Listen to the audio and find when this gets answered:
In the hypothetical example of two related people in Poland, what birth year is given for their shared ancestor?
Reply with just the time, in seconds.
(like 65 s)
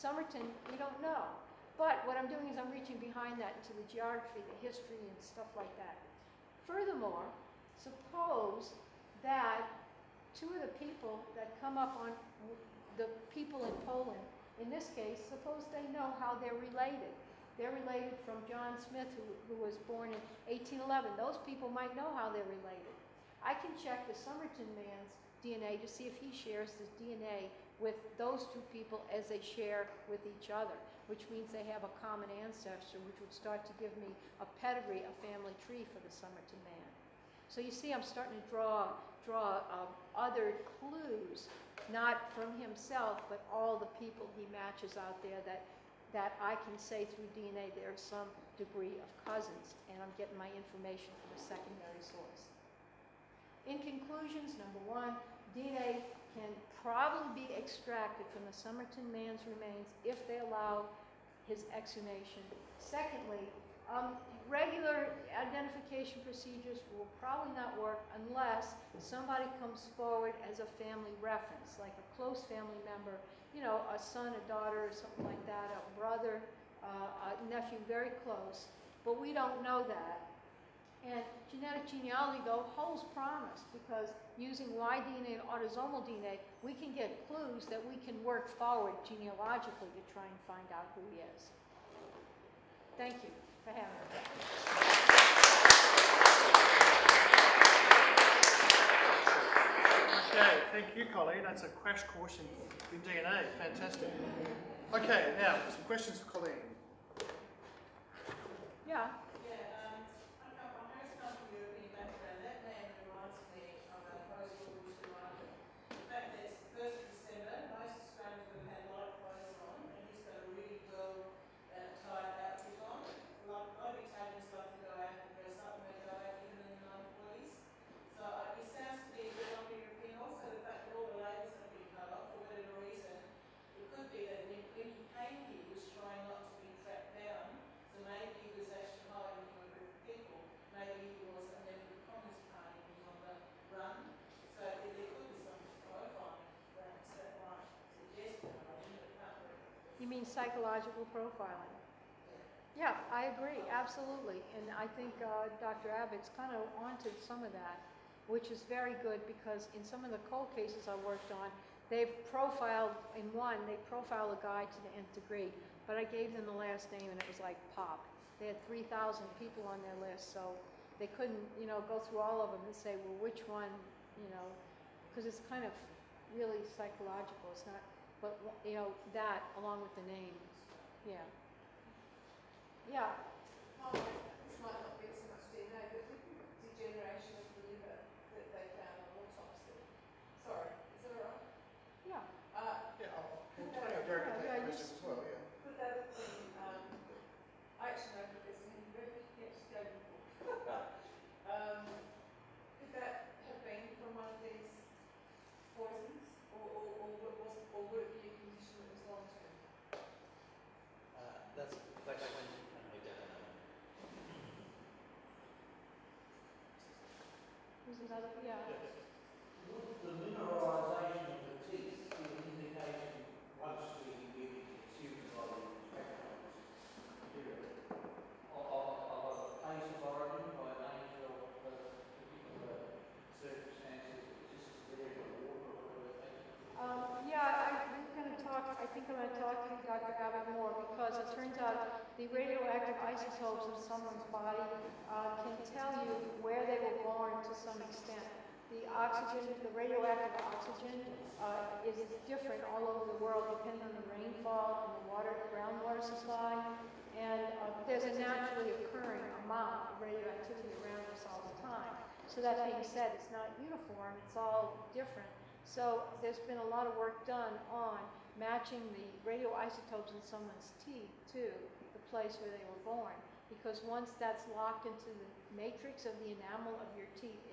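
20 s.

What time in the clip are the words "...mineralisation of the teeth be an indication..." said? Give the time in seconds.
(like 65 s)
220 s.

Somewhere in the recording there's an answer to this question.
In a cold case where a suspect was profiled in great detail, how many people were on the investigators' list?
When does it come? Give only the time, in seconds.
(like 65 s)
168 s.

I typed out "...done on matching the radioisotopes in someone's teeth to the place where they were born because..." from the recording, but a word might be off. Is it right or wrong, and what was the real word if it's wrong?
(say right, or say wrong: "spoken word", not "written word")
right.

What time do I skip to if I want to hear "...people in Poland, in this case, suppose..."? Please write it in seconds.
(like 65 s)
13 s.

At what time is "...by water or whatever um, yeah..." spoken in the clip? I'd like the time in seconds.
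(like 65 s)
235 s.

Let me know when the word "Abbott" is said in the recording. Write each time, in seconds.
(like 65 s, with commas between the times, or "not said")
155 s, 240 s.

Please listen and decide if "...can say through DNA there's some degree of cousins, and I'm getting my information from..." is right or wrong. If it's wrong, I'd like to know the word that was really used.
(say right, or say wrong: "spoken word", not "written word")
right.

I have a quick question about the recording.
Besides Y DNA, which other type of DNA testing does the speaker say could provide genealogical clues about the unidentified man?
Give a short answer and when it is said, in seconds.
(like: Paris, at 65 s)
autosomal DNA, at 85 s.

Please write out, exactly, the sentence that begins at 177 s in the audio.
It's not but, you know, that along with the name.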